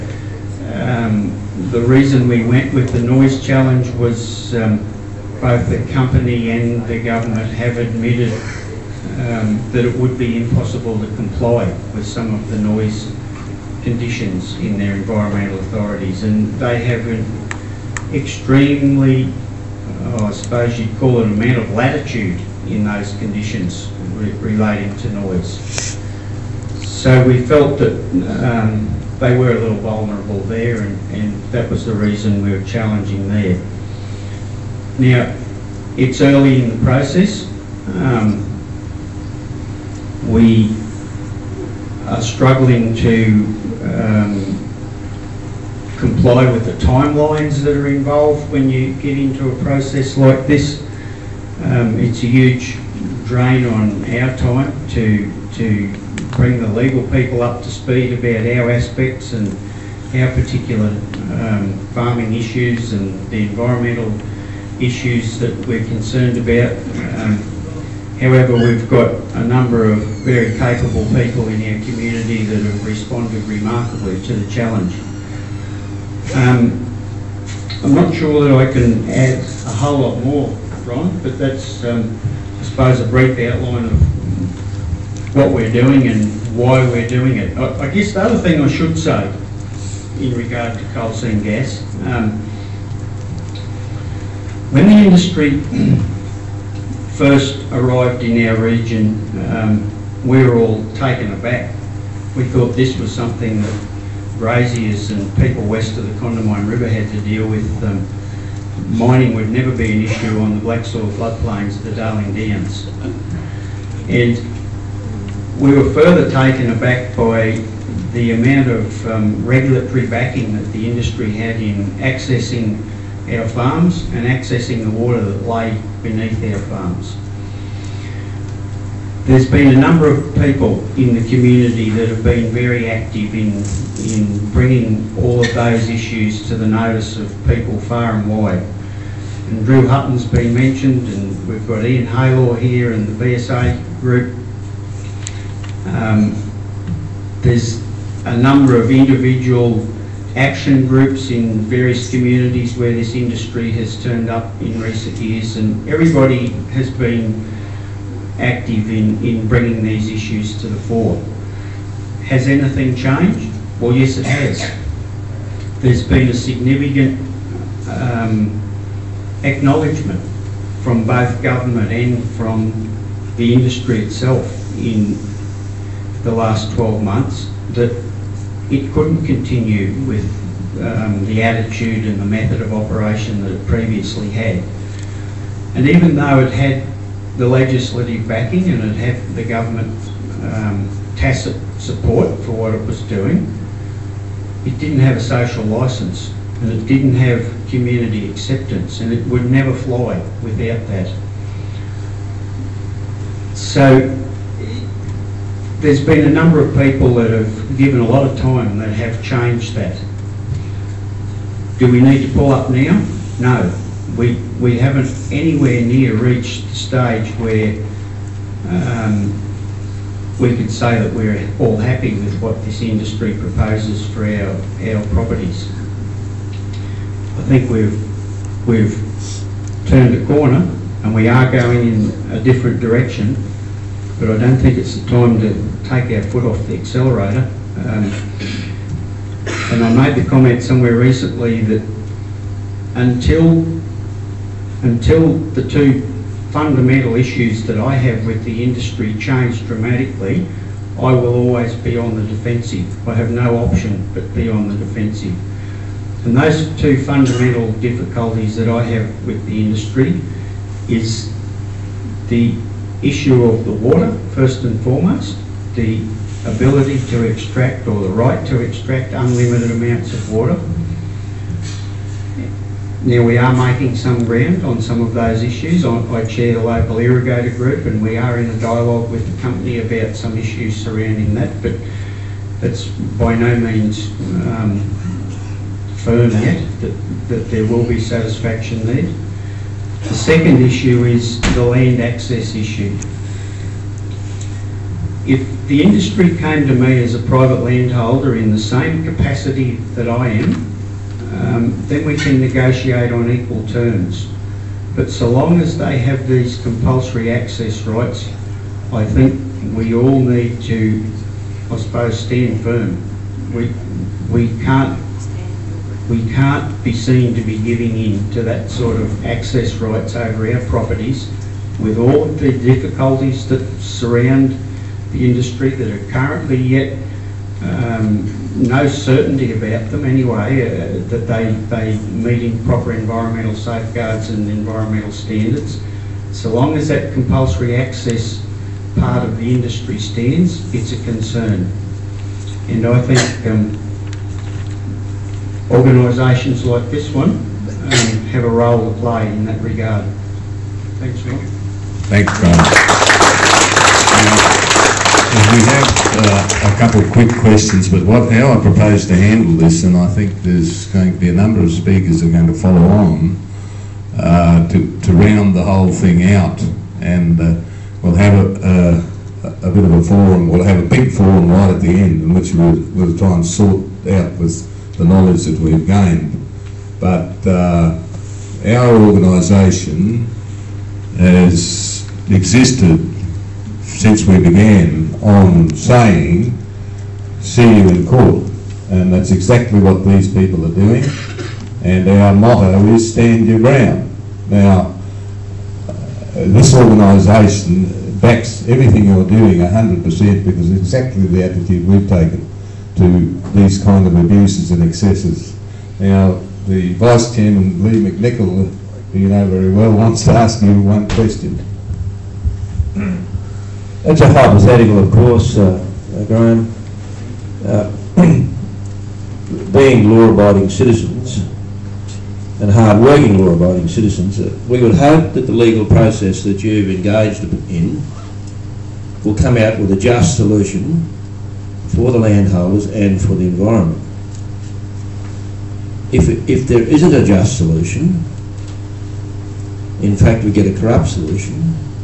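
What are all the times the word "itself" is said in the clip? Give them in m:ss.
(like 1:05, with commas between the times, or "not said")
2:53.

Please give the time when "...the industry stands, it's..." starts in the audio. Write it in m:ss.
5:39.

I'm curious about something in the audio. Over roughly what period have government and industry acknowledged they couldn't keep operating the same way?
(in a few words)
12 months.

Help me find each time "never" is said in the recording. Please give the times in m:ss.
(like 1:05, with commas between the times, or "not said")
1:49, 3:19.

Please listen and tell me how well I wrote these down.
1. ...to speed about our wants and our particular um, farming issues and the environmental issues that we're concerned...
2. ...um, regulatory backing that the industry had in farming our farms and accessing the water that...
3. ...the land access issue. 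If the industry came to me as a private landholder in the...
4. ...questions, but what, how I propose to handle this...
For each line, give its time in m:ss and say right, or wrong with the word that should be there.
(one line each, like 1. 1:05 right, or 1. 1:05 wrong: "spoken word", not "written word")
1. 0:57 wrong: "aspects", not "wants"
2. 1:59 wrong: "accessing", not "farming"
3. 4:51 right
4. 5:57 right.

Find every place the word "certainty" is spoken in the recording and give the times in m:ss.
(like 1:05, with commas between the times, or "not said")
5:28.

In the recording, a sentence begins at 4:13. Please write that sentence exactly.
I have no option but be on the defensive.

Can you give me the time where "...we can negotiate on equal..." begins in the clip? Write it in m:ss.
5:02.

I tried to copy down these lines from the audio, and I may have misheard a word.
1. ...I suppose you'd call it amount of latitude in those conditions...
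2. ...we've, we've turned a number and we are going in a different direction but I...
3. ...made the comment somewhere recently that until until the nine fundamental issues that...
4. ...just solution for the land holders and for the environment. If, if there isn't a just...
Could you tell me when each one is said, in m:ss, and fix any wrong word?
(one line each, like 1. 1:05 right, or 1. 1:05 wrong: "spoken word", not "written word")
1. 0:20 right
2. 3:47 wrong: "corner", not "number"
3. 3:59 wrong: "two", not "nine"
4. 7:09 right.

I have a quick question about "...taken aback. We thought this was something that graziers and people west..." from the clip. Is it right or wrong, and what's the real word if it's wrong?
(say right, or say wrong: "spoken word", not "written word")
right.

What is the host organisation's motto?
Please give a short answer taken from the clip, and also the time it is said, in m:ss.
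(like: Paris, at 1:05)
Stand your ground, at 6:33.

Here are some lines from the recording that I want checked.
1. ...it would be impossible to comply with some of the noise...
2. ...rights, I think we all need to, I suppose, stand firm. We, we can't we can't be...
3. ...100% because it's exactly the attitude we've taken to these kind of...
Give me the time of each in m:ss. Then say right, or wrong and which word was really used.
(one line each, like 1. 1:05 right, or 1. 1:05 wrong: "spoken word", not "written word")
1. 0:09 right
2. 5:07 right
3. 6:39 right.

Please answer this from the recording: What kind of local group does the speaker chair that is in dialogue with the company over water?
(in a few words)
Irrigator group.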